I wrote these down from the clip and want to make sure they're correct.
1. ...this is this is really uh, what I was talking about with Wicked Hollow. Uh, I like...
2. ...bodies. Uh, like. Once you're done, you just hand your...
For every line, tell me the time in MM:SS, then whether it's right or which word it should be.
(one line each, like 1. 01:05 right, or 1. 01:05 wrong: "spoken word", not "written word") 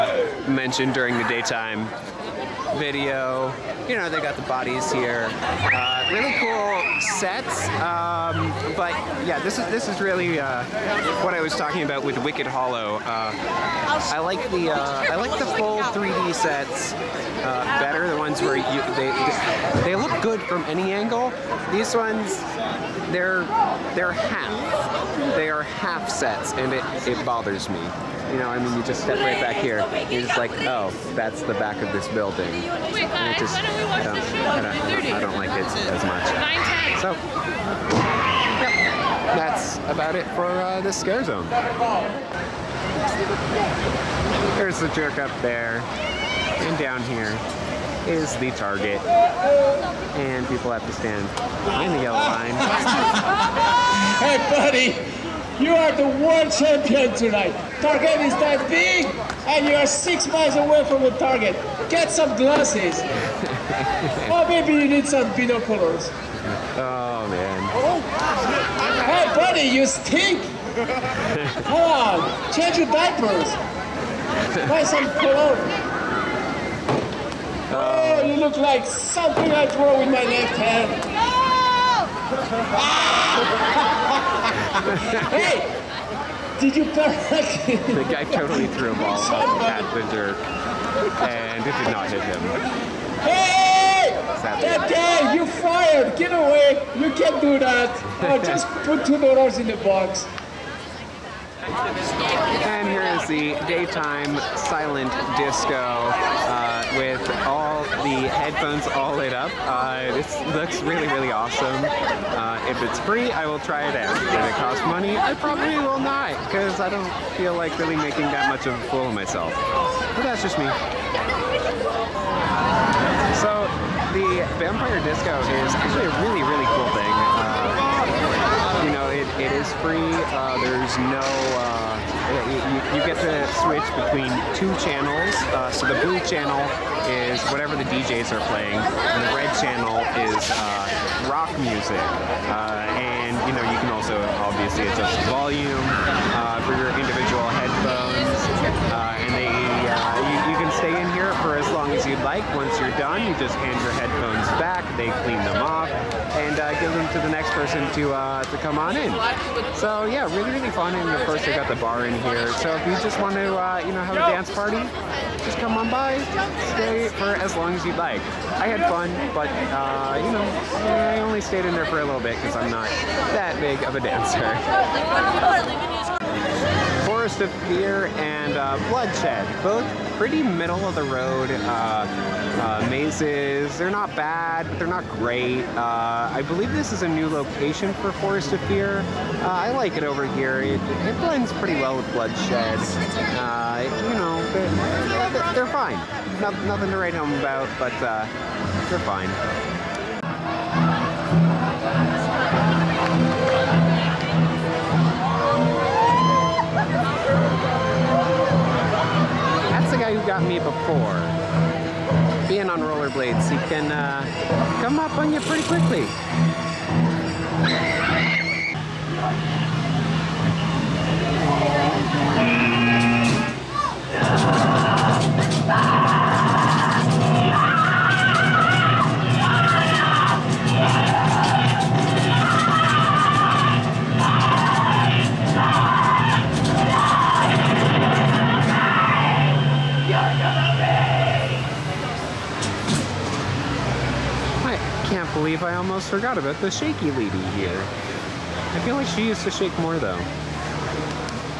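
1. 00:09 right
2. 02:27 wrong: "headphones", not "bodies".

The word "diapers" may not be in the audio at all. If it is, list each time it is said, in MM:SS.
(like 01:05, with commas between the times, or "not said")
01:12.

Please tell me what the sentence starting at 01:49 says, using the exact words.
Uh, this looks really, really awesome.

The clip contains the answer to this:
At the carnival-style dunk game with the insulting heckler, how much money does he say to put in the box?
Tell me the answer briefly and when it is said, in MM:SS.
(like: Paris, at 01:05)
2 dollars, at 01:39.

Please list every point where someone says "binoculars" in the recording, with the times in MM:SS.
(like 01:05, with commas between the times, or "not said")
01:05.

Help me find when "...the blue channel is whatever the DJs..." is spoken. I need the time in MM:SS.
02:15.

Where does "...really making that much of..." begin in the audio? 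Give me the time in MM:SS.
01:57.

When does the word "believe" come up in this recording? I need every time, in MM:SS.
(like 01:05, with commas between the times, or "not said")
03:06, 04:05.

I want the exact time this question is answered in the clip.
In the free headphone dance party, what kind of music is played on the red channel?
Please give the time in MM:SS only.
02:21.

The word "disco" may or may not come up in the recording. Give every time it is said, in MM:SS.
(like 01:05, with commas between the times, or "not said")
01:45, 02:05.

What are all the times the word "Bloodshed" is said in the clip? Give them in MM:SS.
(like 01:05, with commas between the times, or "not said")
02:58, 03:12.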